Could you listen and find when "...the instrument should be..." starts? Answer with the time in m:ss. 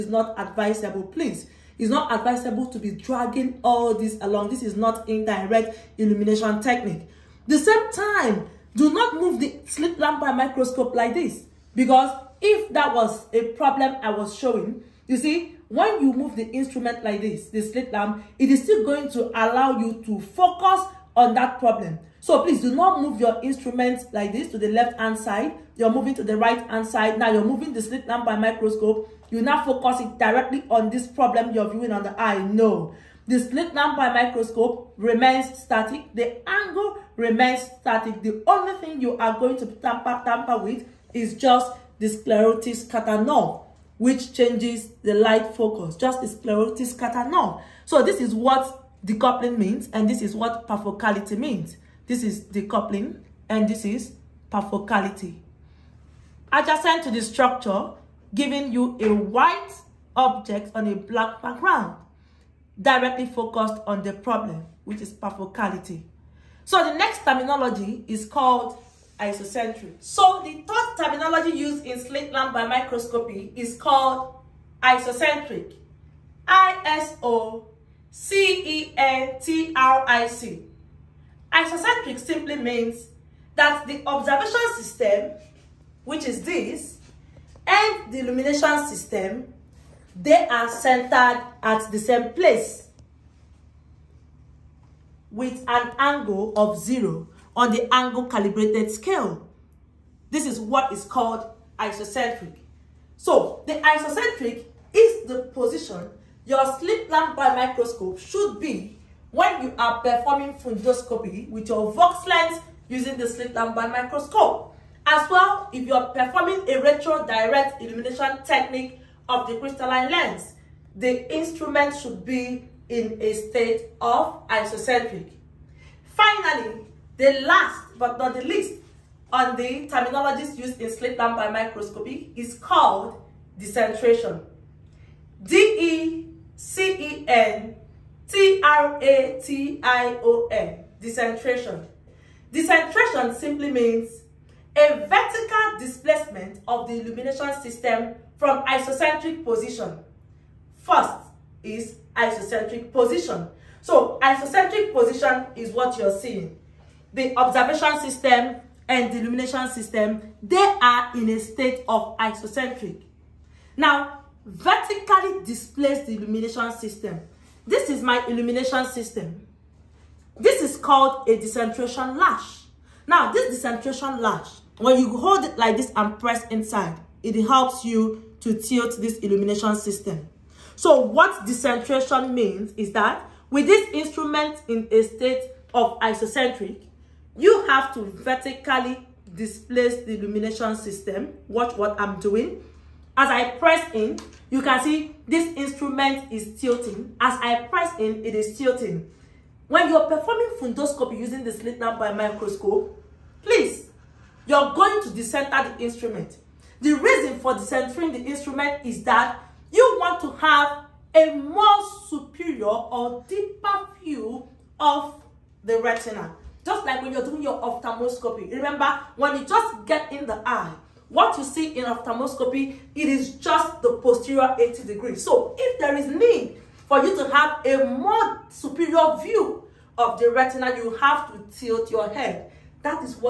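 2:00.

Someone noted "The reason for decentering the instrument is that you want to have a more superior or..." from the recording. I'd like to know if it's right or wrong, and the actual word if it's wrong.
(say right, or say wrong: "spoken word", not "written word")
right.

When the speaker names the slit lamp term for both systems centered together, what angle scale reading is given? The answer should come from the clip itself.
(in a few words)
0.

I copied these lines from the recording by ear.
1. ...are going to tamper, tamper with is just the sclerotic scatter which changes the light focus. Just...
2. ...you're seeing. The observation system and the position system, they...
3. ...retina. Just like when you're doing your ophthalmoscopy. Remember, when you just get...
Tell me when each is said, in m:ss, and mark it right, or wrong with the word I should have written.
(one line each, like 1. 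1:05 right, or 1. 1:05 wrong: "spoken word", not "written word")
1. 0:39 right
2. 2:35 wrong: "illumination", not "position"
3. 3:35 right.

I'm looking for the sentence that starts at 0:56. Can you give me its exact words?
Adjacent to the structure, giving you a white object on a black background, directly focused on the problem, which is perfocality.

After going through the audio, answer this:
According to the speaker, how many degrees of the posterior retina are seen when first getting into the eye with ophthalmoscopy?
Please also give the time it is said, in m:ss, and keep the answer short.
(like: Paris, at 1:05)
80, at 3:44.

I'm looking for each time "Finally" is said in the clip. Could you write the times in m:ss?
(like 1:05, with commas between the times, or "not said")
2:06.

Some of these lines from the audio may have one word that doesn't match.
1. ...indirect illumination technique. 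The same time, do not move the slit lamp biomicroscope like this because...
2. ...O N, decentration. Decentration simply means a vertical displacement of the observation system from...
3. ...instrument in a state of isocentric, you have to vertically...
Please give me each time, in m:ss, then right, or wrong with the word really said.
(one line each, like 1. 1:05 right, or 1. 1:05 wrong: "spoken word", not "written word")
1. 0:05 right
2. 2:20 wrong: "illumination", not "observation"
3. 3:03 right.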